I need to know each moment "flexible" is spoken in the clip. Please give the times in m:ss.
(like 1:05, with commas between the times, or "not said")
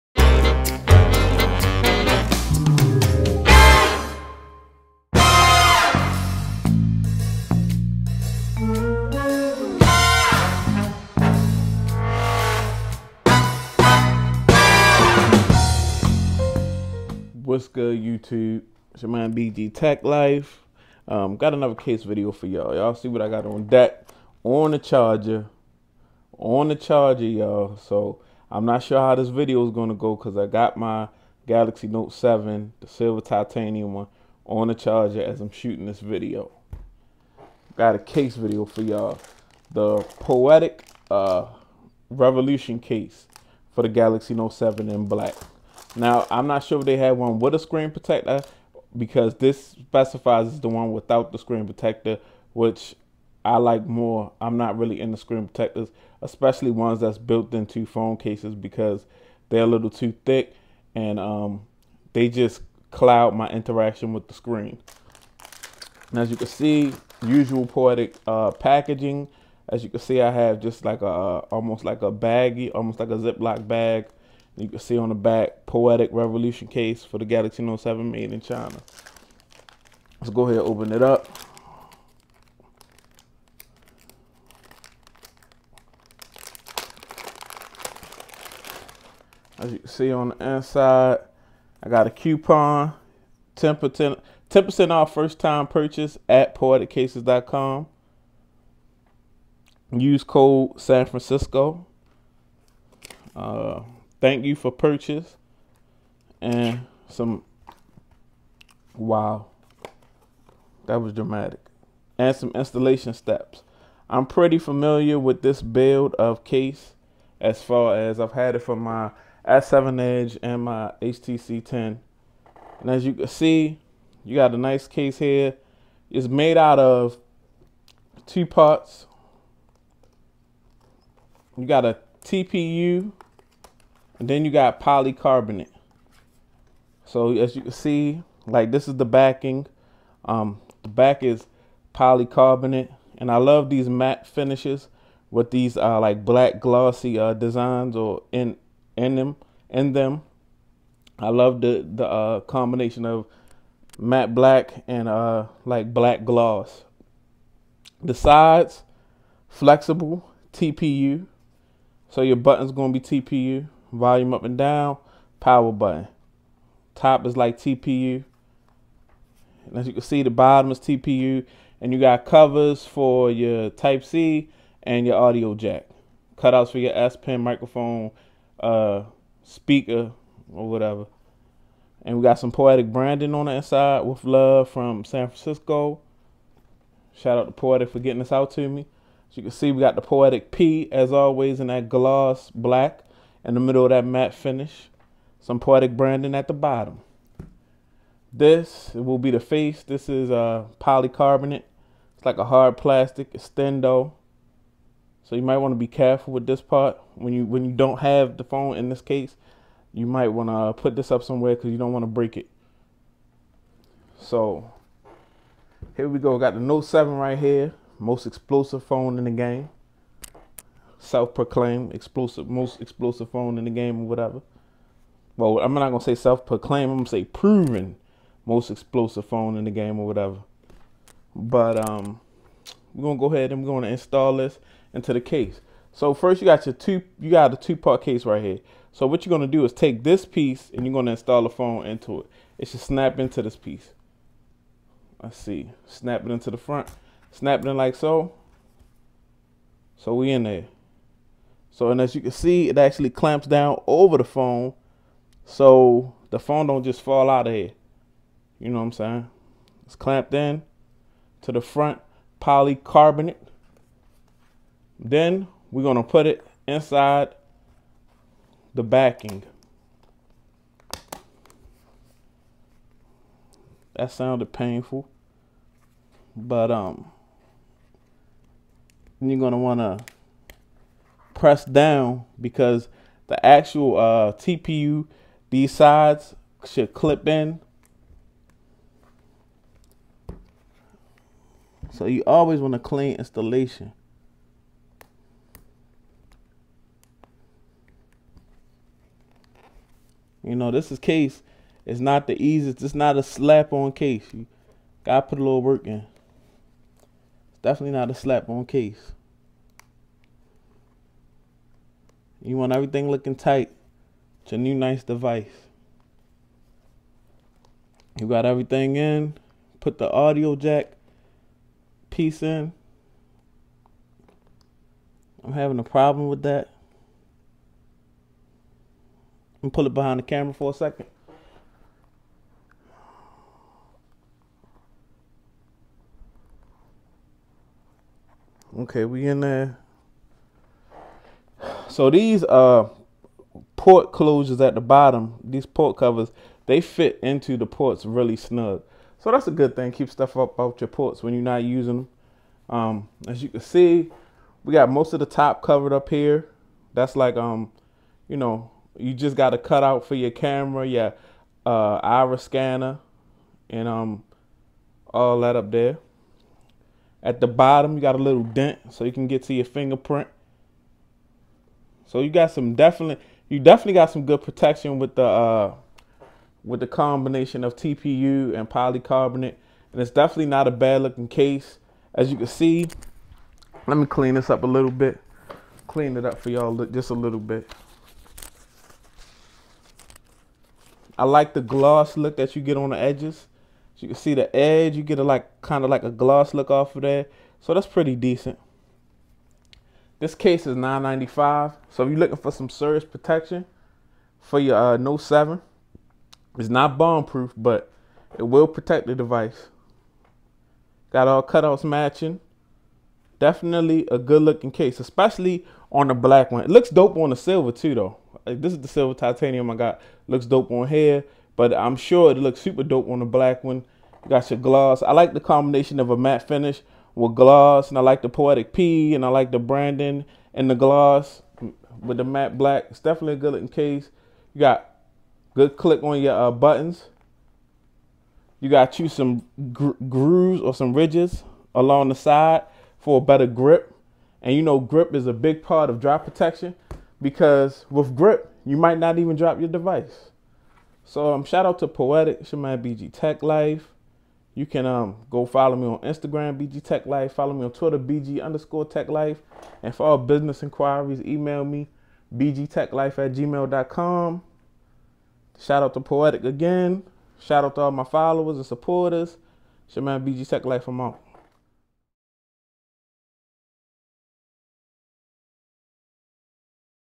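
2:39.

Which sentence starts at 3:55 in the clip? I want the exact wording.
So first, you got your two, you got a two-part case right here.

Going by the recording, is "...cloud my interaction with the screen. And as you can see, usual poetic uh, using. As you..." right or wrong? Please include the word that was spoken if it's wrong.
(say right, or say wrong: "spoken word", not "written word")
wrong: "packaging", not "using".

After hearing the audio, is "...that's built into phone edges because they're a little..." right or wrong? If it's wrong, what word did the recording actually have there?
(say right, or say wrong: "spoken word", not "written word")
wrong: "cases", not "edges".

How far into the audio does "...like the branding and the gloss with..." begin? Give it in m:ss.
7:09.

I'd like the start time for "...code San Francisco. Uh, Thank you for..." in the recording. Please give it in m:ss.
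1:40.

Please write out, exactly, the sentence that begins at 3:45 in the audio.
Well, I'm not gonna say self-proclaimed.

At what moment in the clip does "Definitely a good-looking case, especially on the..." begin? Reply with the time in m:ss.
6:53.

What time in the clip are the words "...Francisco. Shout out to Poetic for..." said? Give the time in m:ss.
3:05.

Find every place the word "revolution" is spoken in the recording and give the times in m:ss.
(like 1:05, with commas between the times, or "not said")
0:42, 1:16.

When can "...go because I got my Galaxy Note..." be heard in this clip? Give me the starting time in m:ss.
0:29.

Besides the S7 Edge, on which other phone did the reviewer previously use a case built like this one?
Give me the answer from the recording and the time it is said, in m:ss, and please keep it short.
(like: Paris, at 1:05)
HTC 10, at 2:01.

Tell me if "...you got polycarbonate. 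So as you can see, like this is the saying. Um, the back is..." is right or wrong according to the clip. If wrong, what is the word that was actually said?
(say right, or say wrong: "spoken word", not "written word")
wrong: "backing", not "saying".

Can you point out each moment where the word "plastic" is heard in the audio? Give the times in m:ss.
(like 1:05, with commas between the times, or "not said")
3:22.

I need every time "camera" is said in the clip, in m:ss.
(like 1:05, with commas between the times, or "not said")
5:30, 6:00.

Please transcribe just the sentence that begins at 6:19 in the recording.
And it's definitely not a bad looking case.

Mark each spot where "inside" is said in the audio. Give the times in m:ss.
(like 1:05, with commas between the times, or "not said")
1:30, 3:03, 4:26.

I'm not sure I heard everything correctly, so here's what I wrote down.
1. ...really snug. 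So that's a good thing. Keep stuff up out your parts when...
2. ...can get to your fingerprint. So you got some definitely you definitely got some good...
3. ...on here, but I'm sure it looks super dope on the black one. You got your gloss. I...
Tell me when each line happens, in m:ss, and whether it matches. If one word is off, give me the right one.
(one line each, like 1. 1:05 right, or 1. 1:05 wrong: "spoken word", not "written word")
1. 5:48 wrong: "ports", not "parts"
2. 6:09 right
3. 7:00 right.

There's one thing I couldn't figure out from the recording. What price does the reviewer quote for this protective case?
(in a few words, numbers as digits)
$9.95.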